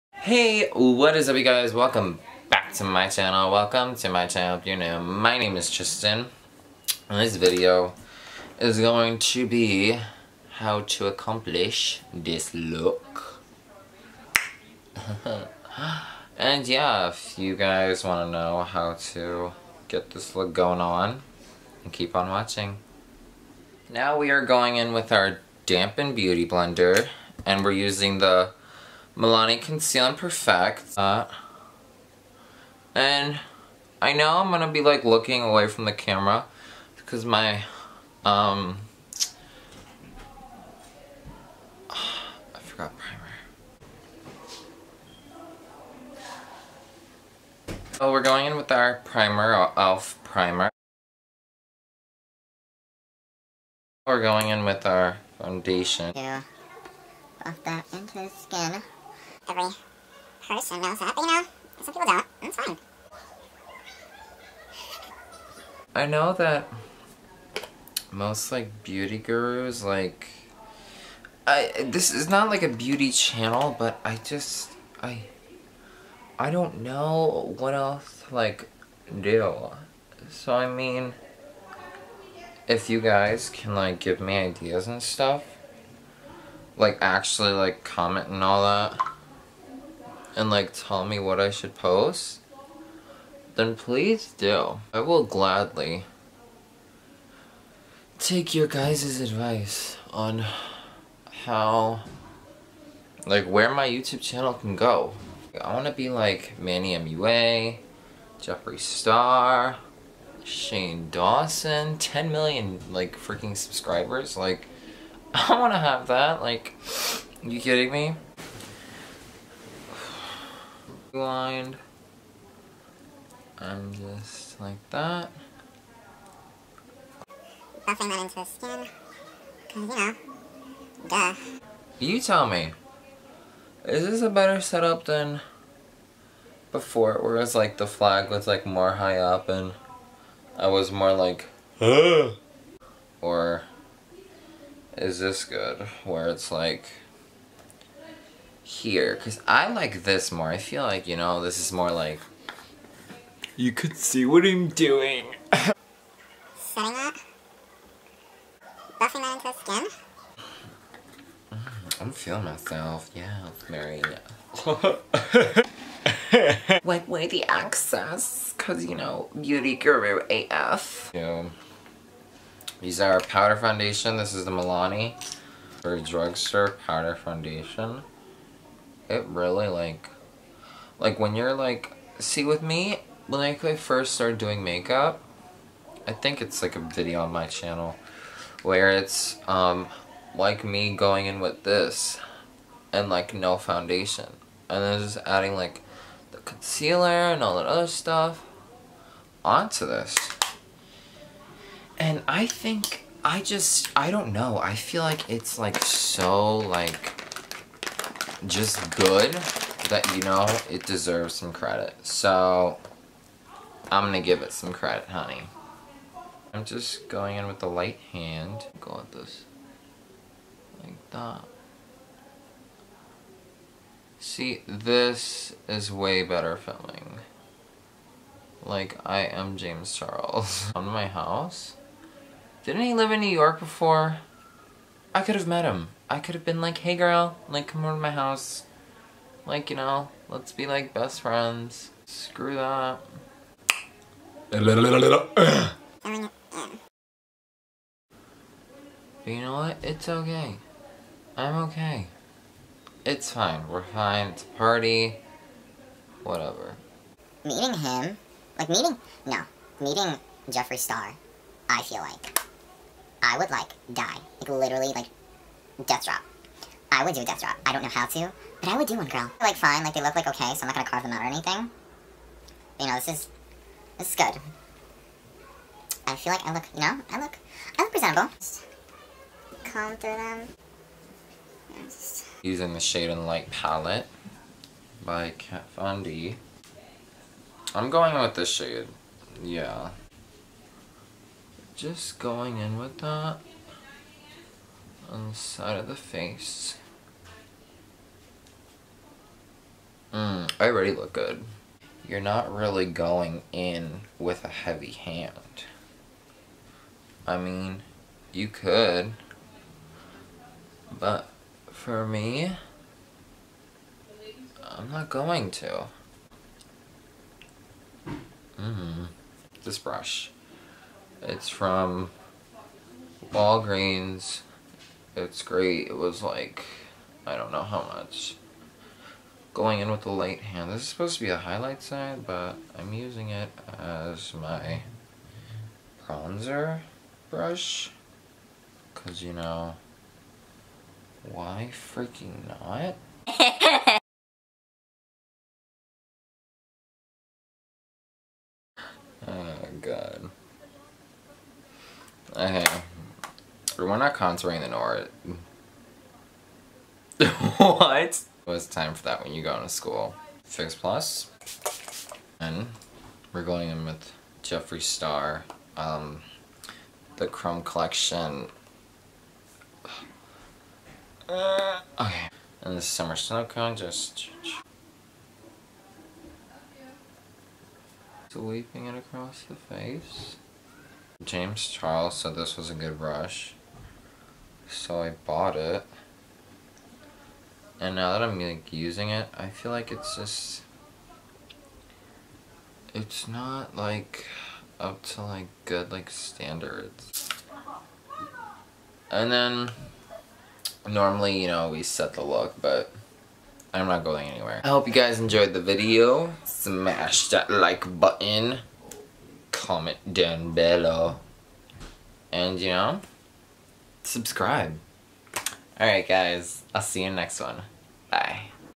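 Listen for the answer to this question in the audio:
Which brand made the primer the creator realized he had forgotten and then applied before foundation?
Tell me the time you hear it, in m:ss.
0:49.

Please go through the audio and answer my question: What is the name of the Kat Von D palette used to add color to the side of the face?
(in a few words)
Shade and Light.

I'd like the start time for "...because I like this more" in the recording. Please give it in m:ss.
2:29.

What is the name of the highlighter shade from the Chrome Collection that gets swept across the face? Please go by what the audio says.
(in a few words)
Summer Snow Cone.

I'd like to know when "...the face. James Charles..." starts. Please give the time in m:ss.
6:19.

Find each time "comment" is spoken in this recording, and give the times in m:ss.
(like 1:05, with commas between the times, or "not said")
1:27, 6:49.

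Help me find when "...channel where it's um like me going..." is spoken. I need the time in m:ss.
3:07.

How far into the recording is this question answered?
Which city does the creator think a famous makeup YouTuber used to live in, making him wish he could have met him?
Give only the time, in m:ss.
3:53.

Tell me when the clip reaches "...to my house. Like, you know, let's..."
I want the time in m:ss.
3:57.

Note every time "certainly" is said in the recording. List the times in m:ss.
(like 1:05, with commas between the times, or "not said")
not said.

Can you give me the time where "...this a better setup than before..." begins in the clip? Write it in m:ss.
2:14.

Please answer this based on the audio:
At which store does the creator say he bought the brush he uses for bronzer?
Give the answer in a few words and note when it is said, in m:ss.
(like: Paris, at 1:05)
Walgreens, at 5:23.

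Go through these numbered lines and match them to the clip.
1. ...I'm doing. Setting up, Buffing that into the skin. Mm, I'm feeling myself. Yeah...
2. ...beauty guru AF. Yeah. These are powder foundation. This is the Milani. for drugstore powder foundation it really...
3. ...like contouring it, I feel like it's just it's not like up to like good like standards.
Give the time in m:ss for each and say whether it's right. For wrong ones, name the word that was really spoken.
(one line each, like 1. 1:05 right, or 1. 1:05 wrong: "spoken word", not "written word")
1. 2:34 right
2. 2:49 right
3. 6:28 wrong: "using", not "contouring".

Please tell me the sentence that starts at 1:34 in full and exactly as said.
I will gladly take your guys' advice on how, like where my YouTube channel can go.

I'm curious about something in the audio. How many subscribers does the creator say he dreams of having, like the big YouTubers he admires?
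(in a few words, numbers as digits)
10 million.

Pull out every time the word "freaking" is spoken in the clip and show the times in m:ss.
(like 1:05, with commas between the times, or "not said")
1:53, 5:41.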